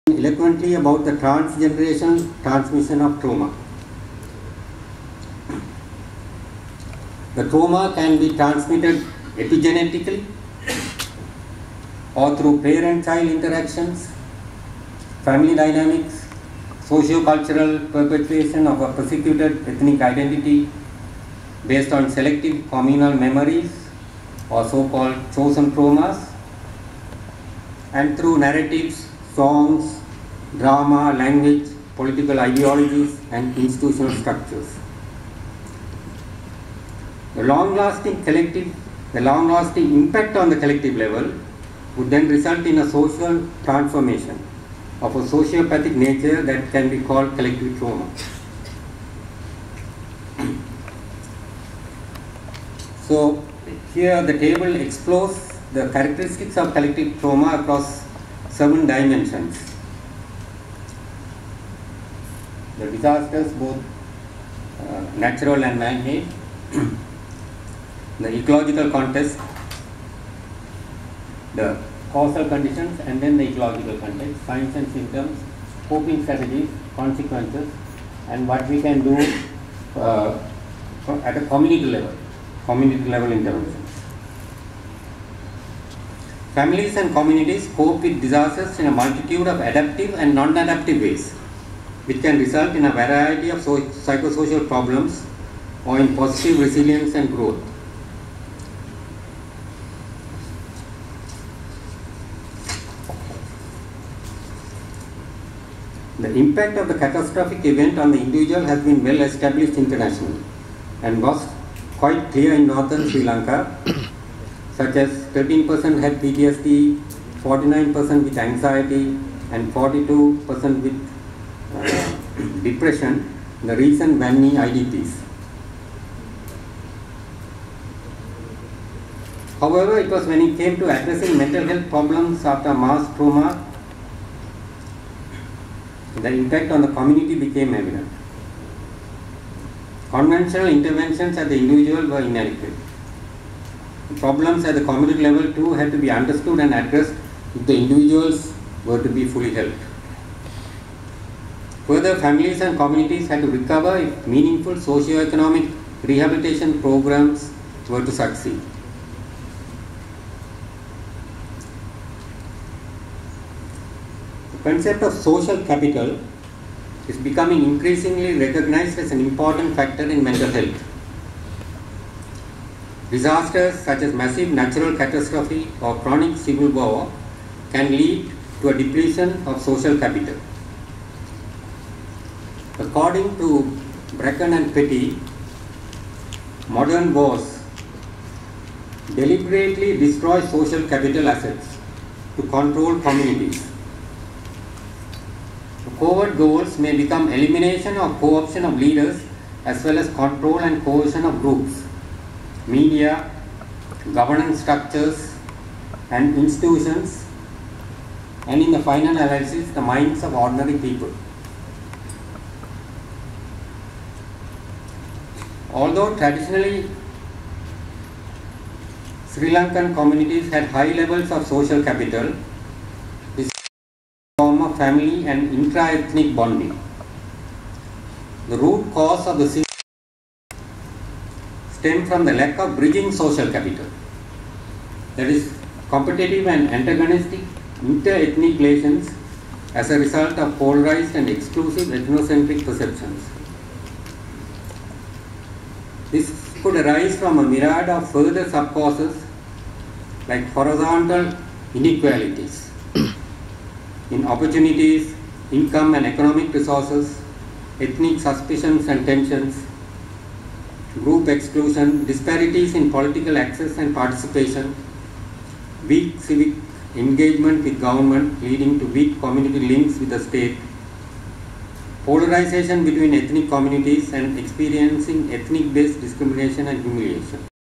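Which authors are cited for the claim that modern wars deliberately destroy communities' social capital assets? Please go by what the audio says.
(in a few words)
Bracken and Petty.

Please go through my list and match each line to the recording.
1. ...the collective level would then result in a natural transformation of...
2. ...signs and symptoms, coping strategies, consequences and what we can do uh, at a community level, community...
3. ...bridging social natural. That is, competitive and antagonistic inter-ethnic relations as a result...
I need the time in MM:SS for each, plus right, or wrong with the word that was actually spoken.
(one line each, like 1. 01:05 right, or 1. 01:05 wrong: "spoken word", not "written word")
1. 00:40 wrong: "social", not "natural"
2. 01:14 right
3. 03:52 wrong: "capital", not "natural".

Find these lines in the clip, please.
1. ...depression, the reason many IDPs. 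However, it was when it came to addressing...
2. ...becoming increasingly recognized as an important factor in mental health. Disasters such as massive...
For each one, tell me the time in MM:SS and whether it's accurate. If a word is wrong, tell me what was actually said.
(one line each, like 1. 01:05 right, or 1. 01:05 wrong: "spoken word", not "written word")
1. 02:02 right
2. 02:47 right.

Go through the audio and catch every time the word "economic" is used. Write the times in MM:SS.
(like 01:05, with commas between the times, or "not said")
02:34, 04:16.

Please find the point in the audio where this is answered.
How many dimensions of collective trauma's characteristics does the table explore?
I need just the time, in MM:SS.
00:58.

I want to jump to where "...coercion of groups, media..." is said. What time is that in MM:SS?
03:20.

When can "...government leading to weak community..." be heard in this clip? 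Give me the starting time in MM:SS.
04:27.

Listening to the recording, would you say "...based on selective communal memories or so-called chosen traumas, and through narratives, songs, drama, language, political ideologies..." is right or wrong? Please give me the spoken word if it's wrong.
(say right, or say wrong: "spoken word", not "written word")
right.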